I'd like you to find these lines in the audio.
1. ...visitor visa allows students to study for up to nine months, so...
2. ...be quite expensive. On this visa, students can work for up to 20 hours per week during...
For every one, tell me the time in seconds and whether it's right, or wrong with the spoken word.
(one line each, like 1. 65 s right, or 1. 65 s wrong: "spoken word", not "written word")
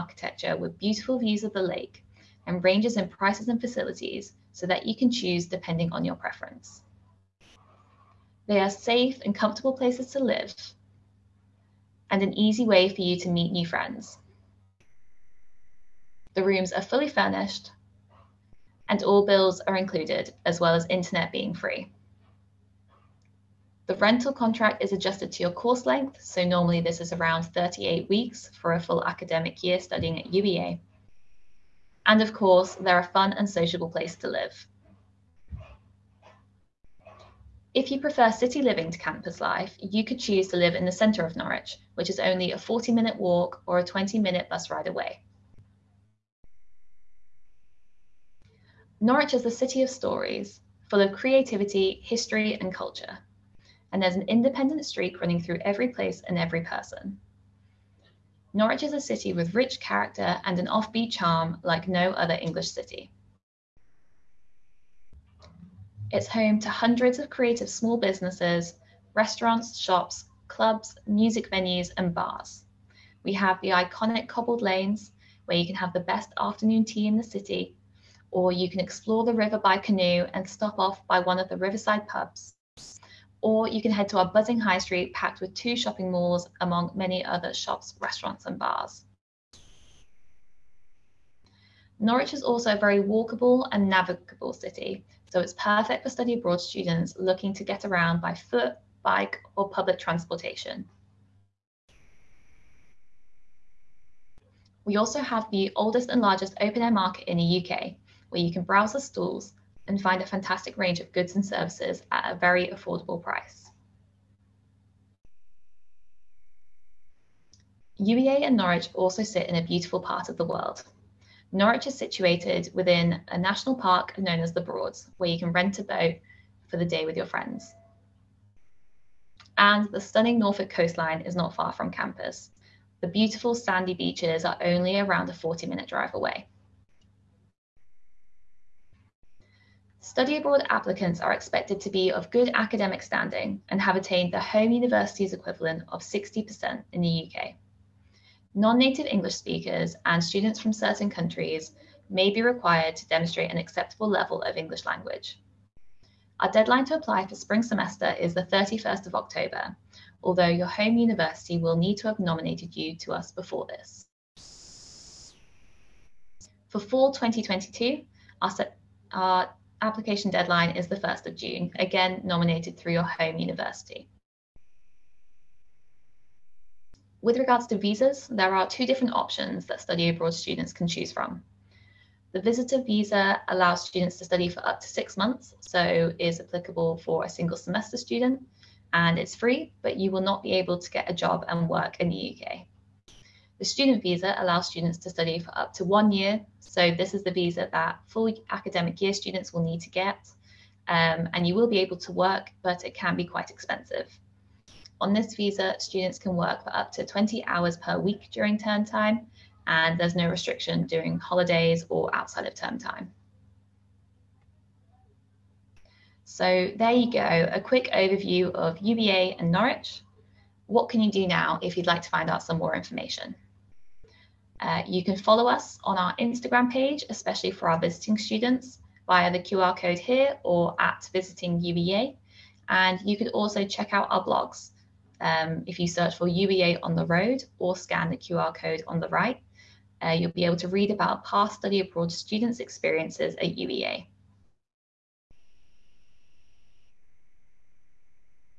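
1. 182 s wrong: "six", not "nine"
2. 203 s right.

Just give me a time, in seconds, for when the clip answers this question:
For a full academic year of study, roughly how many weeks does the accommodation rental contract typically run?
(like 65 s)
27 s.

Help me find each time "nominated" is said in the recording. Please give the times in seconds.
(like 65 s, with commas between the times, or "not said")
162 s, 172 s.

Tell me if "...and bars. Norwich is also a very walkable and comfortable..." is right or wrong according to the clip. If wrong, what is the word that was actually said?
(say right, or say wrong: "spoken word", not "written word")
wrong: "navigable", not "comfortable".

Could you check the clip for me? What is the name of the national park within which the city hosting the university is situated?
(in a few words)
the Broads.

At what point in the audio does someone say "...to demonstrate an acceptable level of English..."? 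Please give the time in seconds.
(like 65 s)
152 s.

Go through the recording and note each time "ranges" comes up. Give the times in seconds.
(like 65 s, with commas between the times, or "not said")
2 s, 110 s.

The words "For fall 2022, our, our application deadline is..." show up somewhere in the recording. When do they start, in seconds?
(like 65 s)
166 s.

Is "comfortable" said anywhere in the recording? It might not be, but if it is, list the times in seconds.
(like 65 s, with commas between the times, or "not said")
9 s.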